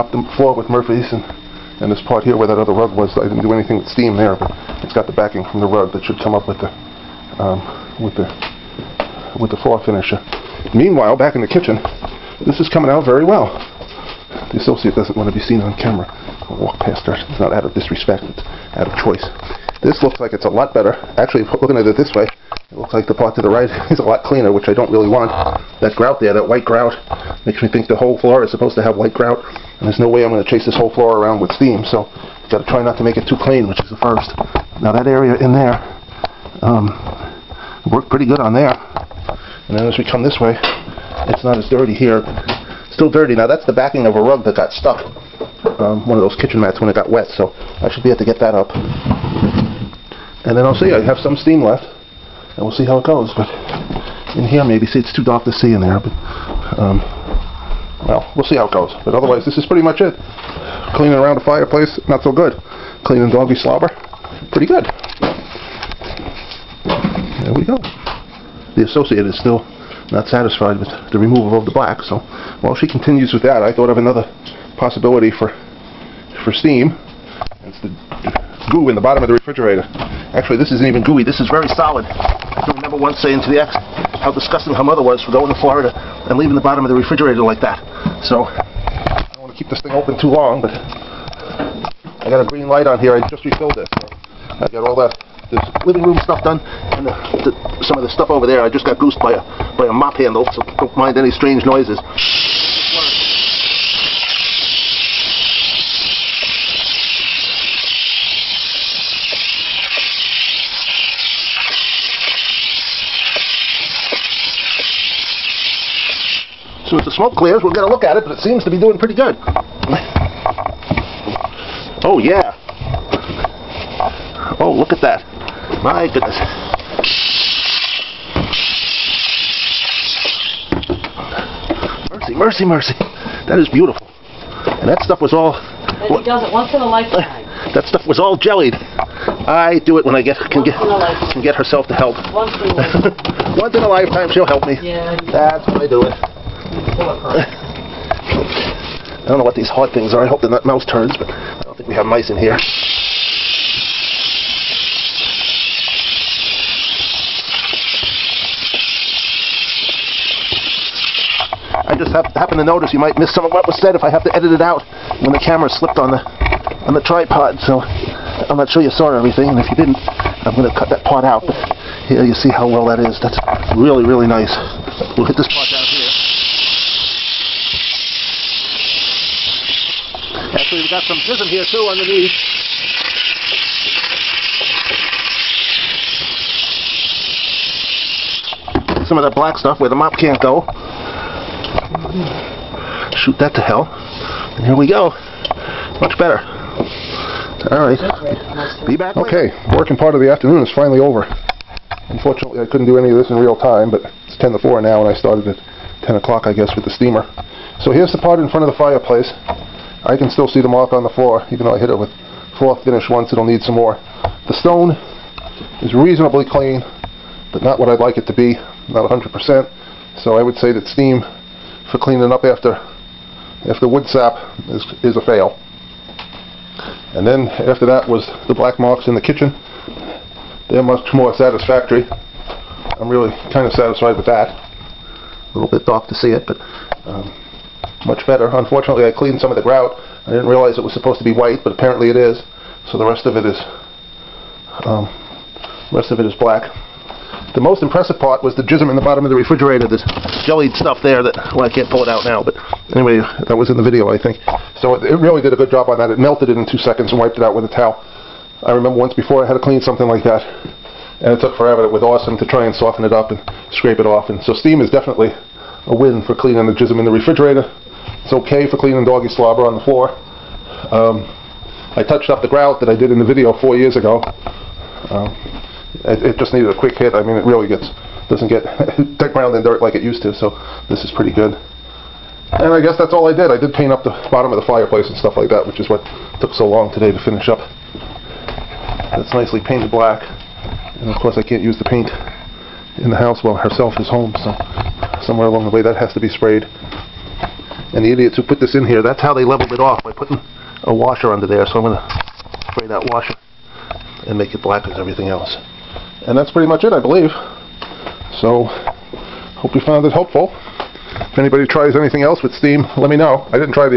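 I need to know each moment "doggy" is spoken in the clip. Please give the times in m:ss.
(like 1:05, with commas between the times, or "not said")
1:03, 4:29.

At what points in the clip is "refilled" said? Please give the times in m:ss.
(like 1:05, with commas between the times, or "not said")
1:33.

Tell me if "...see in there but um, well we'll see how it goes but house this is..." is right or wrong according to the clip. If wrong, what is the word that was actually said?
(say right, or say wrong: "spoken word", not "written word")
wrong: "otherwise", not "house".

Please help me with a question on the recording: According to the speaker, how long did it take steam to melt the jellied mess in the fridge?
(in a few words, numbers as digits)
2 seconds.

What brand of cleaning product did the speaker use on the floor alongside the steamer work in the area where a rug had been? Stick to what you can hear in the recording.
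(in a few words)
Murphy's.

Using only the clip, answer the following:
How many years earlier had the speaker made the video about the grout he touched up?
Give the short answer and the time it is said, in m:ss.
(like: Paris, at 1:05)
4 years, at 4:33.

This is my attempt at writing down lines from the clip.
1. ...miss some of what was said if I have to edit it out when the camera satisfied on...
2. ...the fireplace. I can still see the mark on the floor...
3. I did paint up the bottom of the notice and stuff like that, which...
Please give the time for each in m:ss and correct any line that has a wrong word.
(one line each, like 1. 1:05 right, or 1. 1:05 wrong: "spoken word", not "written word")
1. 2:43 wrong: "slipped", not "satisfied"
2. 3:28 right
3. 4:43 wrong: "fireplace", not "notice".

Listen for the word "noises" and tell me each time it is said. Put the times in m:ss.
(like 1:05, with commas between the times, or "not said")
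1:41.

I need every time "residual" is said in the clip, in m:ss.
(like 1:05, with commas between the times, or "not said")
not said.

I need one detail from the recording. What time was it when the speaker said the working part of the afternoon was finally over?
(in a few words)
10 to 4.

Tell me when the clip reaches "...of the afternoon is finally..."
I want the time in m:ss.
3:20.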